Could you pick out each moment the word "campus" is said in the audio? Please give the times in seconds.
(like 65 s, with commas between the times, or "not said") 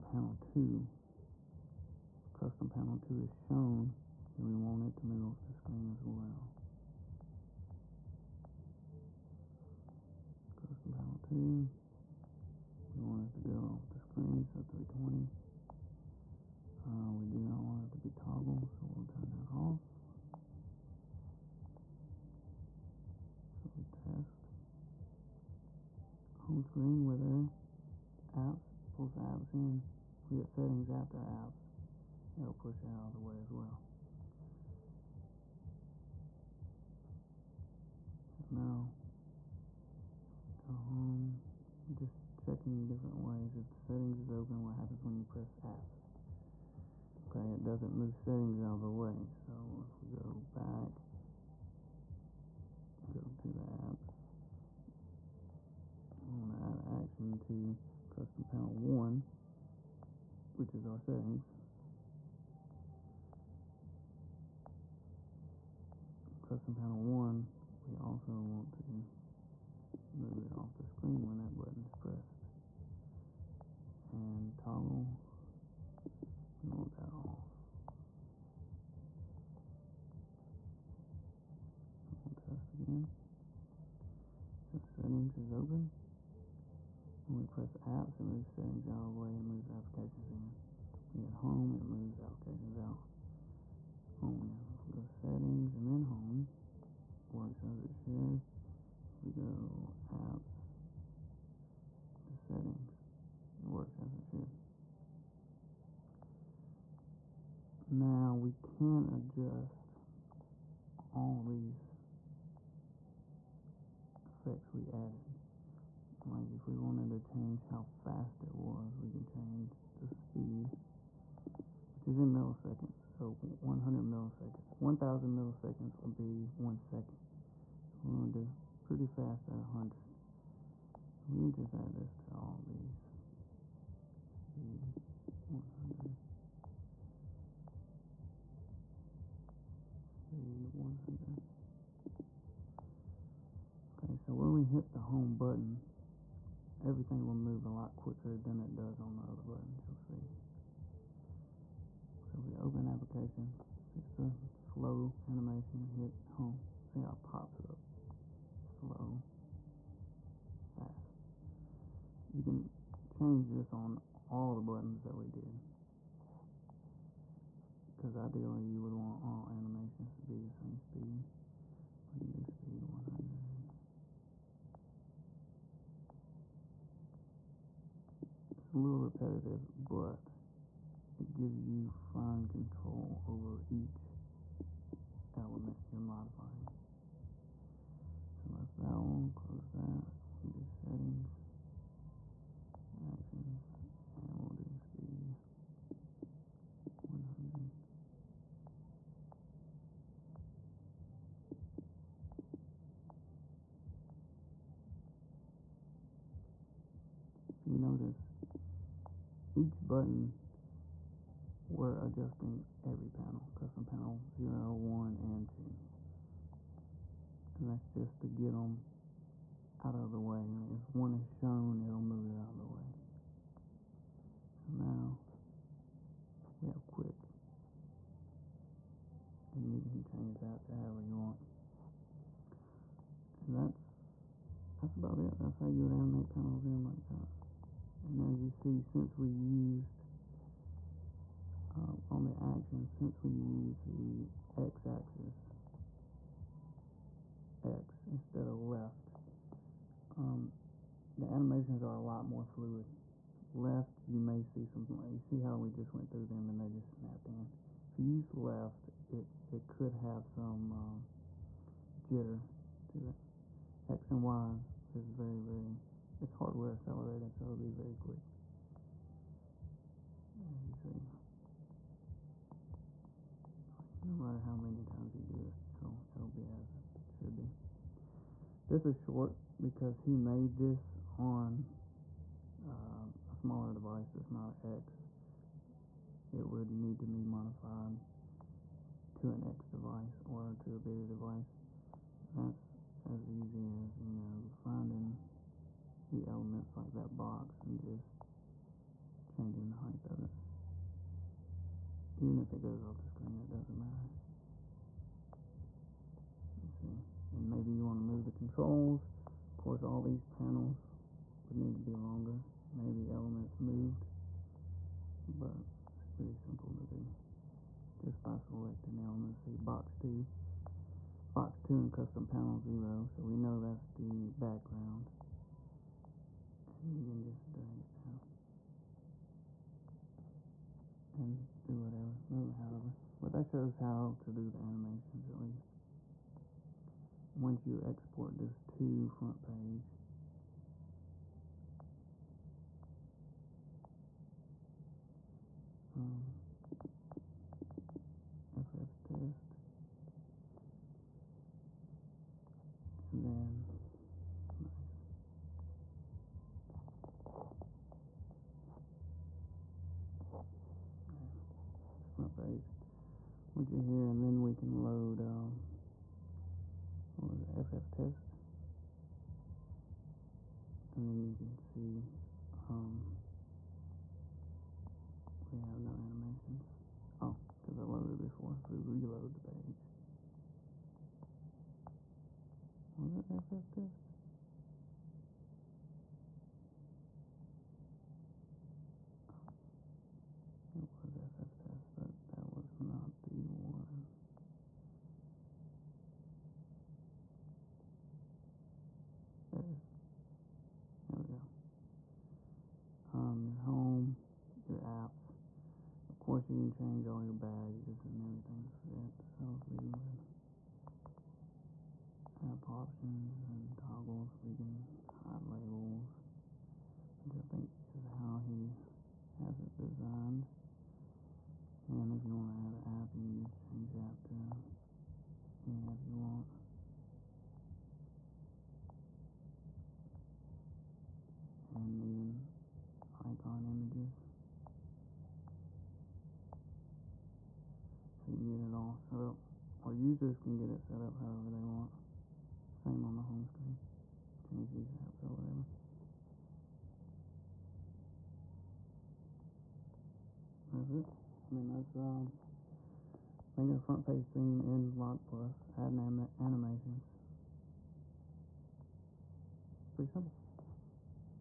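not said.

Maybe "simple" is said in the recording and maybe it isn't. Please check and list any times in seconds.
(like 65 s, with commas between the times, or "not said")
316 s, 460 s.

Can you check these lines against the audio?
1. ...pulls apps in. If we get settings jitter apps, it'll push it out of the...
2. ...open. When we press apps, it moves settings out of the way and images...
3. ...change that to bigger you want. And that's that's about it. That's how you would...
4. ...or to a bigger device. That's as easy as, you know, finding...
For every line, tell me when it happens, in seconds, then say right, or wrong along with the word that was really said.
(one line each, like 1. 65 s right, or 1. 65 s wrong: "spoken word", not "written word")
1. 28 s wrong: "after", not "jitter"
2. 85 s wrong: "moves", not "images"
3. 230 s wrong: "however", not "bigger"
4. 290 s right.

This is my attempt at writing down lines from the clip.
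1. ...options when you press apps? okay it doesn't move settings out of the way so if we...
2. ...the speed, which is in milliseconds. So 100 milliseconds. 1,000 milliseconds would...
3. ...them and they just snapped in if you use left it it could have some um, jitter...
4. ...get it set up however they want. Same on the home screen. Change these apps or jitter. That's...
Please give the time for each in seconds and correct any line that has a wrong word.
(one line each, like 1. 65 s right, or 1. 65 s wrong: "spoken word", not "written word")
1. 44 s wrong: "happens", not "options"
2. 120 s right
3. 256 s right
4. 440 s wrong: "whatever", not "jitter".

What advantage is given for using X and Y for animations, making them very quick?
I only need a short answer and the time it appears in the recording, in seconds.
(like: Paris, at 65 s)
hardware accelerated, at 266 s.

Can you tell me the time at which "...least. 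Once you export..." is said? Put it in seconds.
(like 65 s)
335 s.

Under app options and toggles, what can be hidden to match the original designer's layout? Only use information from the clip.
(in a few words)
labels.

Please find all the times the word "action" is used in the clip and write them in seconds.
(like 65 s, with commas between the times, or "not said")
57 s, 193 s, 242 s.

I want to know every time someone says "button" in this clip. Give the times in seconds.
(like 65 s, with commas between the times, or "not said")
71 s, 145 s, 149 s, 164 s, 209 s.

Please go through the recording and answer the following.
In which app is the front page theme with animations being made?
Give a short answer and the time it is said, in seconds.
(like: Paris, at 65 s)
Lock Plus, at 454 s.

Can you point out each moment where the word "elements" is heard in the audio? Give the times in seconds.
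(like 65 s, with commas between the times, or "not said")
185 s, 296 s, 313 s, 319 s.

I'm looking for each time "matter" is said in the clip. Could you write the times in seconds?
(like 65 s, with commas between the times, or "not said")
274 s, 303 s.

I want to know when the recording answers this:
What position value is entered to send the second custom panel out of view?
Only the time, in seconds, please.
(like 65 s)
14 s.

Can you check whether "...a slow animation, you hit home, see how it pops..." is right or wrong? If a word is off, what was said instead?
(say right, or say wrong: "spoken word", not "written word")
right.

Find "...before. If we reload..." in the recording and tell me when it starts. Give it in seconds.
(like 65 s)
378 s.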